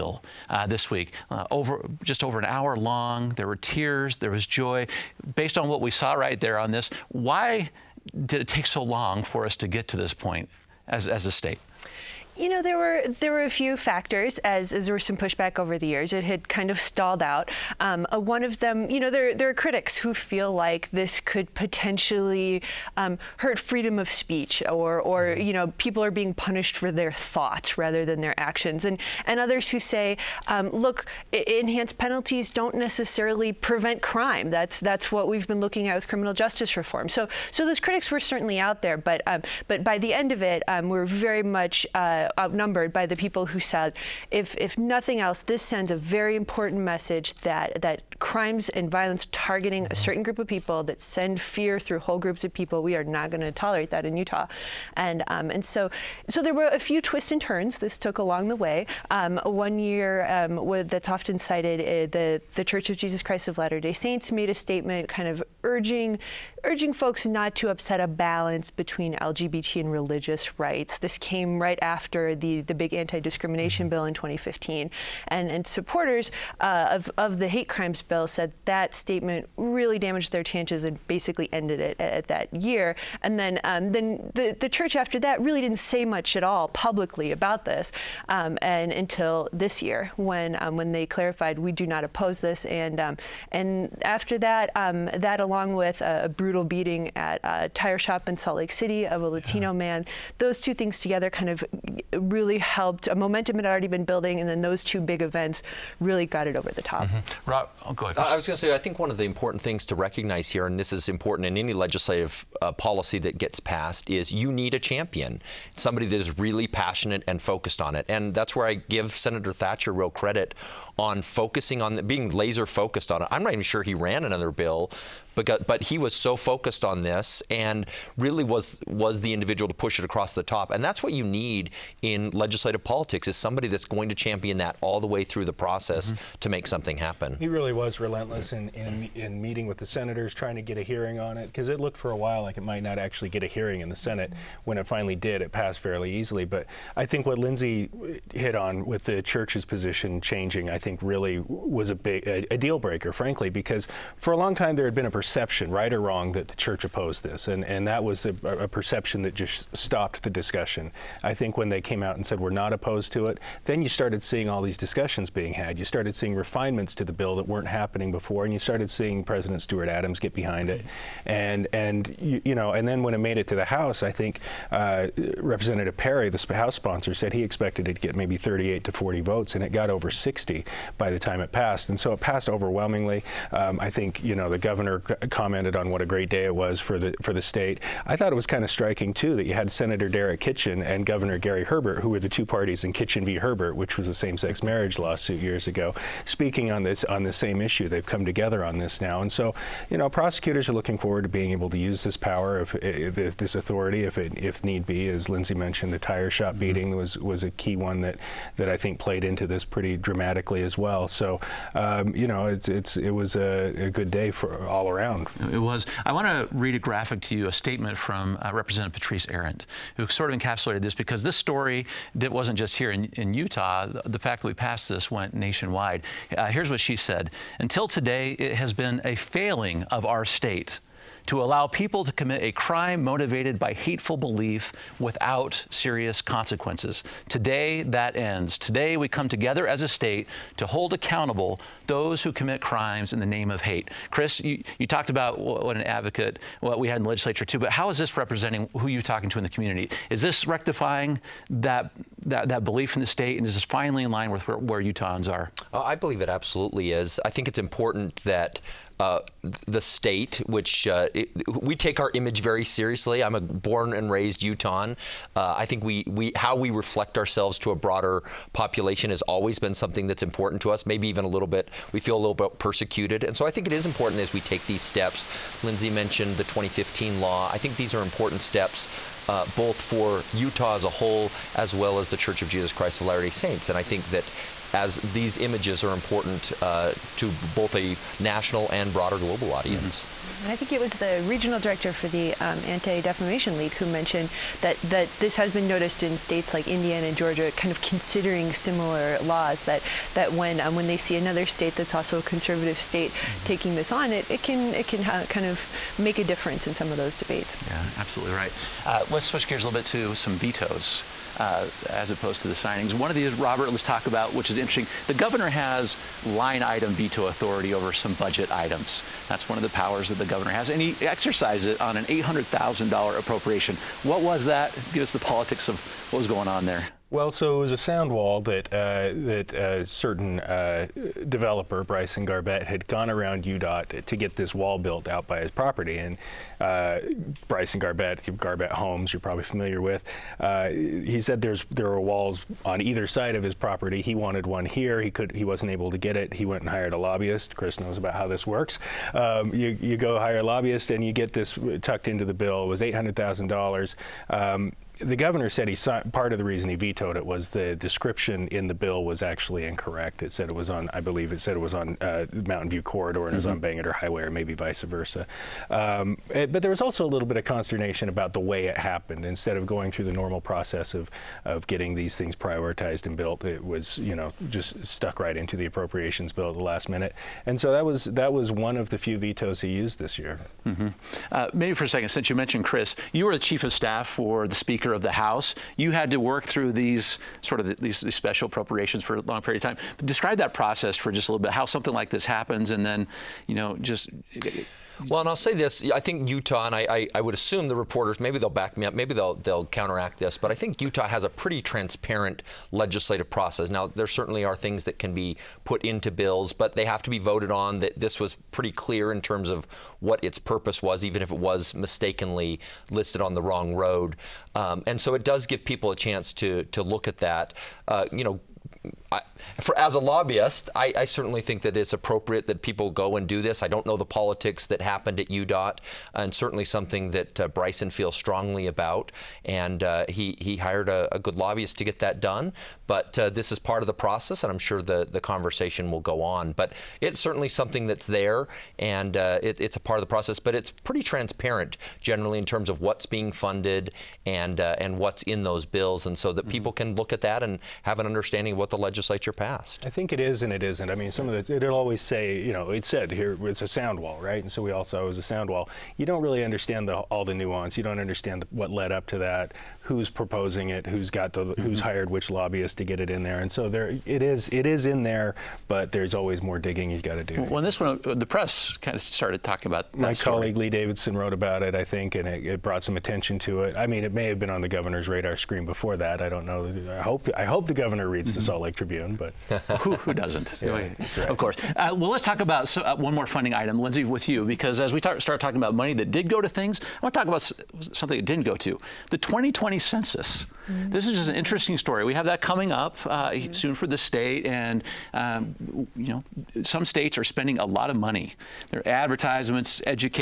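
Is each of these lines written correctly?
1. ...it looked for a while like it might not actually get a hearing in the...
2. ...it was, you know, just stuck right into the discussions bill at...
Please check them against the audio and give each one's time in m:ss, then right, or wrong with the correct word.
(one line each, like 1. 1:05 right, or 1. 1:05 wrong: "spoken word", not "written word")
1. 2:21 right
2. 6:13 wrong: "appropriations", not "discussions".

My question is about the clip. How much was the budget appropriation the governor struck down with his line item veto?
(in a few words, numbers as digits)
$800,000.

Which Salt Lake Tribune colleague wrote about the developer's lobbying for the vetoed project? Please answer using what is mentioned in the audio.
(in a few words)
Lee Davidson.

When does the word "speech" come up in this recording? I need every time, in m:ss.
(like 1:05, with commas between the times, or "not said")
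0:24.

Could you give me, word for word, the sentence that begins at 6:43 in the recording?
Now, there certainly are things that can be put into bills, but they have to be voted on.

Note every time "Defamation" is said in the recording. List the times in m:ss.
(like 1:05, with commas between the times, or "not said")
4:52.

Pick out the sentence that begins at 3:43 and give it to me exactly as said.
The, the, fact that we passed this went nationwide.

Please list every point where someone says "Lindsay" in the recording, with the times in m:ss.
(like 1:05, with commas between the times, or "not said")
2:27, 3:25, 4:35, 8:03.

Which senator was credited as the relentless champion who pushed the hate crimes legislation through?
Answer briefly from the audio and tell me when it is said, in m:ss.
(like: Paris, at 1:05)
Senator Thatcher, at 1:59.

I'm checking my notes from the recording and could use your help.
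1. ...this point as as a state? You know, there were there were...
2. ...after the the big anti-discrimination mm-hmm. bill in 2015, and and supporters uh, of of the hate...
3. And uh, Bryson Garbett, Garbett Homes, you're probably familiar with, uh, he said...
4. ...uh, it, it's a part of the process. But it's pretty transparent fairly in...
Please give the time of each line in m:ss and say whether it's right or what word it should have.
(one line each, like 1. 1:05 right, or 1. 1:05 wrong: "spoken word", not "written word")
1. 0:09 right
2. 1:11 right
3. 5:35 right
4. 7:19 wrong: "generally", not "fairly".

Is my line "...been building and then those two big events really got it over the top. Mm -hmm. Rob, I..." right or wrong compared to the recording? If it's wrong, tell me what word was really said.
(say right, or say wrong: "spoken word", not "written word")
right.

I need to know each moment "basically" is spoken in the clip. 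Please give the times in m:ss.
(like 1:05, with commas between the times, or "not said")
1:21.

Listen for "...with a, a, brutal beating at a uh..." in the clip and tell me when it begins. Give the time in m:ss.
1:35.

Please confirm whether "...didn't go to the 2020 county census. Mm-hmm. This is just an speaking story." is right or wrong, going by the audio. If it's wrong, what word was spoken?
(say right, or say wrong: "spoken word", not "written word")
wrong: "interesting", not "speaking".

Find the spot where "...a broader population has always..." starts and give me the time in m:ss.
4:27.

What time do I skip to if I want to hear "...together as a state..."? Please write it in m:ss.
3:59.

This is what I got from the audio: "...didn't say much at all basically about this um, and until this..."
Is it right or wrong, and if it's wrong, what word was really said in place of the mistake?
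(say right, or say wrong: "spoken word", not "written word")
wrong: "publicly", not "basically".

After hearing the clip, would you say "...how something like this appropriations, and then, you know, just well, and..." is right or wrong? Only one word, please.
wrong.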